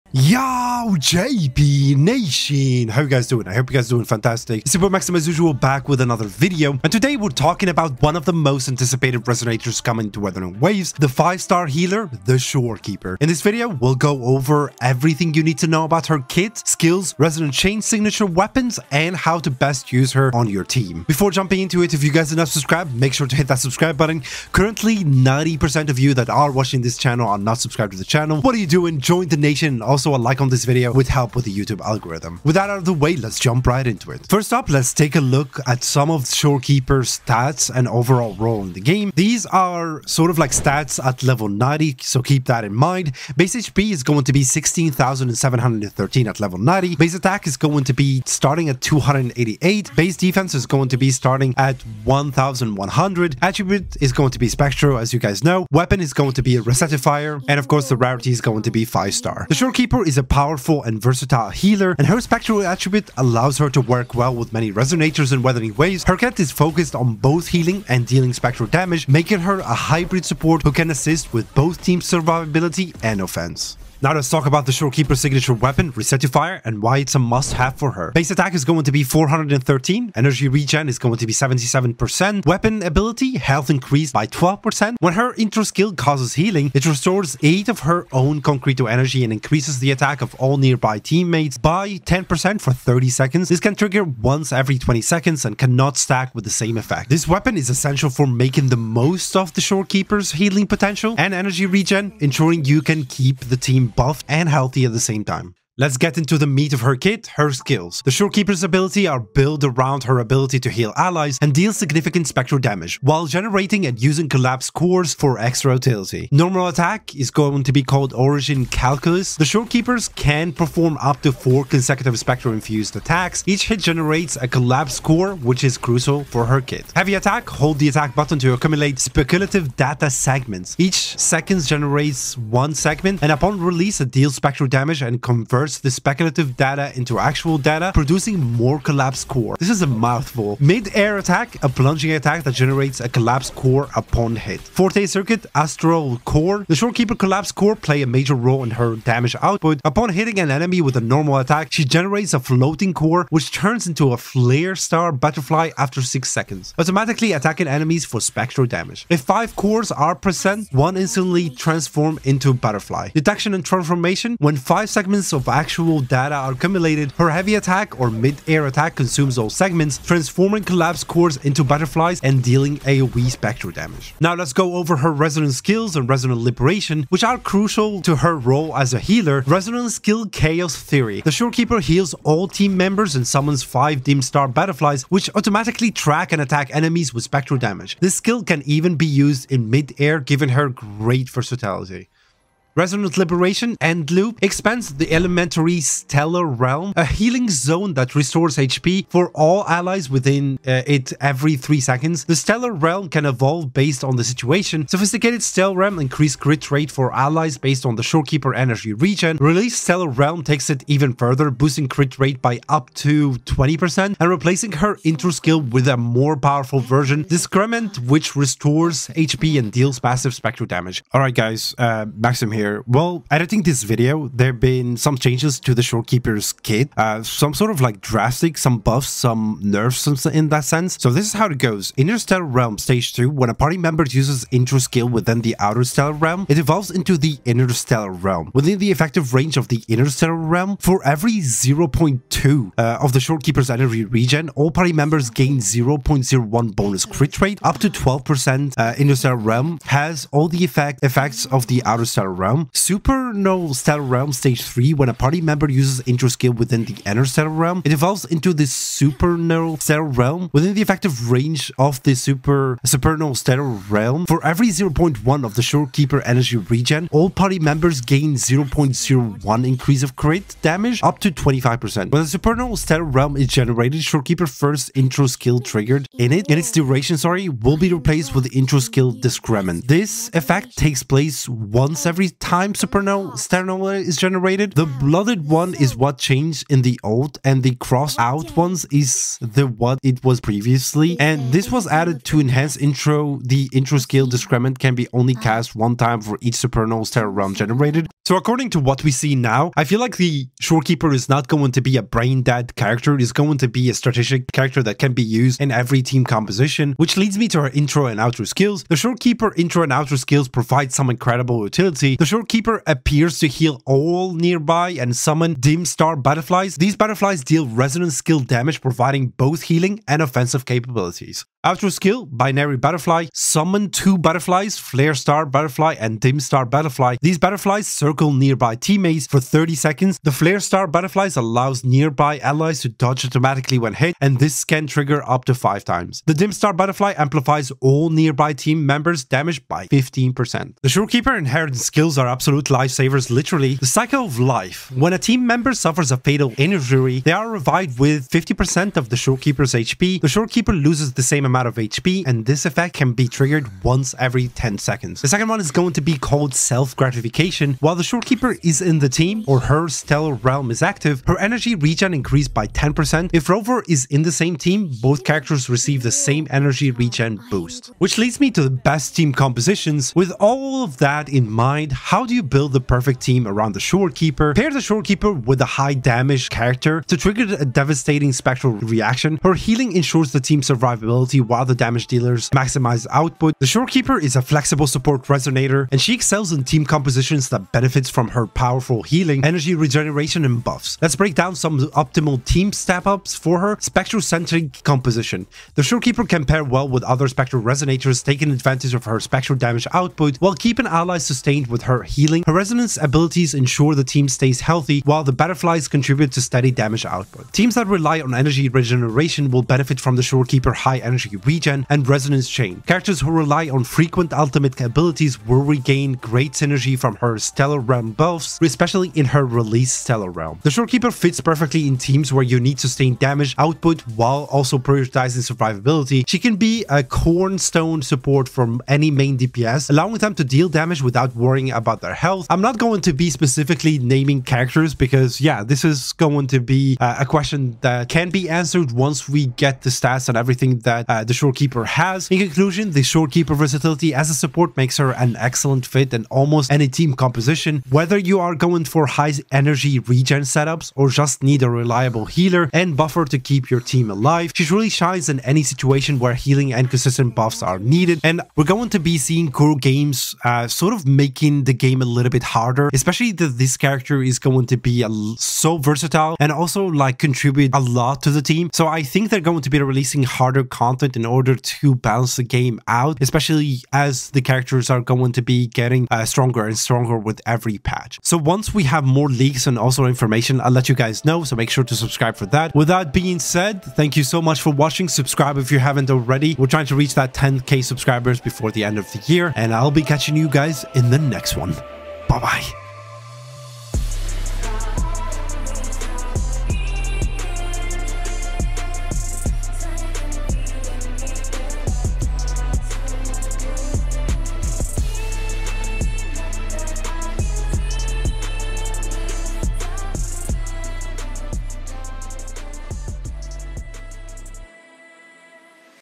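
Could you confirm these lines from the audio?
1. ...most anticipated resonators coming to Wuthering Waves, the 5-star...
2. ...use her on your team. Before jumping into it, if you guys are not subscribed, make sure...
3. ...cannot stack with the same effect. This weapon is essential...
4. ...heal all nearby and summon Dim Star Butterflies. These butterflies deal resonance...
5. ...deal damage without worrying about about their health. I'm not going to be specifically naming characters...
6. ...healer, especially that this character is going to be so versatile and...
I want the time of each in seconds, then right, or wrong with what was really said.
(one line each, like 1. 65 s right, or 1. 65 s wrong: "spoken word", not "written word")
1. 8 s right
2. 19 s right
3. 95 s right
4. 313 s right
5. 430 s right
6. 462 s wrong: "harder", not "healer".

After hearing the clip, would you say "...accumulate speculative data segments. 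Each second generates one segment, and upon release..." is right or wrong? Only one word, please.
right.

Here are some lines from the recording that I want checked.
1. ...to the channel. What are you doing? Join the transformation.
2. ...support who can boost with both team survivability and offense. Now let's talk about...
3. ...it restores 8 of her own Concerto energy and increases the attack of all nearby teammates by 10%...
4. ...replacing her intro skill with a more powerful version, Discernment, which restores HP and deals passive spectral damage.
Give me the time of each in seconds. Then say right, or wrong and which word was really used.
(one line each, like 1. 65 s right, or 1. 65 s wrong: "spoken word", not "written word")
1. 27 s wrong: "nation", not "transformation"
2. 70 s wrong: "assist", not "boost"
3. 86 s right
4. 214 s right.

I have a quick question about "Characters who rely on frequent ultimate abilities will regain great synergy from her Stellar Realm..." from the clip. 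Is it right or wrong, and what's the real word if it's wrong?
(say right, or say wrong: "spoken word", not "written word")
right.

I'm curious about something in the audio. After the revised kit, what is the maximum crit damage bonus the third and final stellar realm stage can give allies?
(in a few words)
25%.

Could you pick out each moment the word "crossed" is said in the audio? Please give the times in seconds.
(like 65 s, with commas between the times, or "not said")
287 s.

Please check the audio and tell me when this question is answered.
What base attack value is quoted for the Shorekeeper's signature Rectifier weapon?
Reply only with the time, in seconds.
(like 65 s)
79 s.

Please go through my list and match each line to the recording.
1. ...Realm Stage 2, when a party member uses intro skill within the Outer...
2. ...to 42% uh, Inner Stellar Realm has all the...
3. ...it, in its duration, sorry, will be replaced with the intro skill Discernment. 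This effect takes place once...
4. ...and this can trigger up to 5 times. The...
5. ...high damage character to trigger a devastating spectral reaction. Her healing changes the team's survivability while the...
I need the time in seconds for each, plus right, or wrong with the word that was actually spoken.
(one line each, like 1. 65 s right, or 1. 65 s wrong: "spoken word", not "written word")
1. 232 s right
2. 247 s wrong: "12", not "42"
3. 276 s right
4. 334 s right
5. 375 s wrong: "ensures", not "changes".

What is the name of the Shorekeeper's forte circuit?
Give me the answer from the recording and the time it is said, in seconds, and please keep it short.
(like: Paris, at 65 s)
Astral Core, at 145 s.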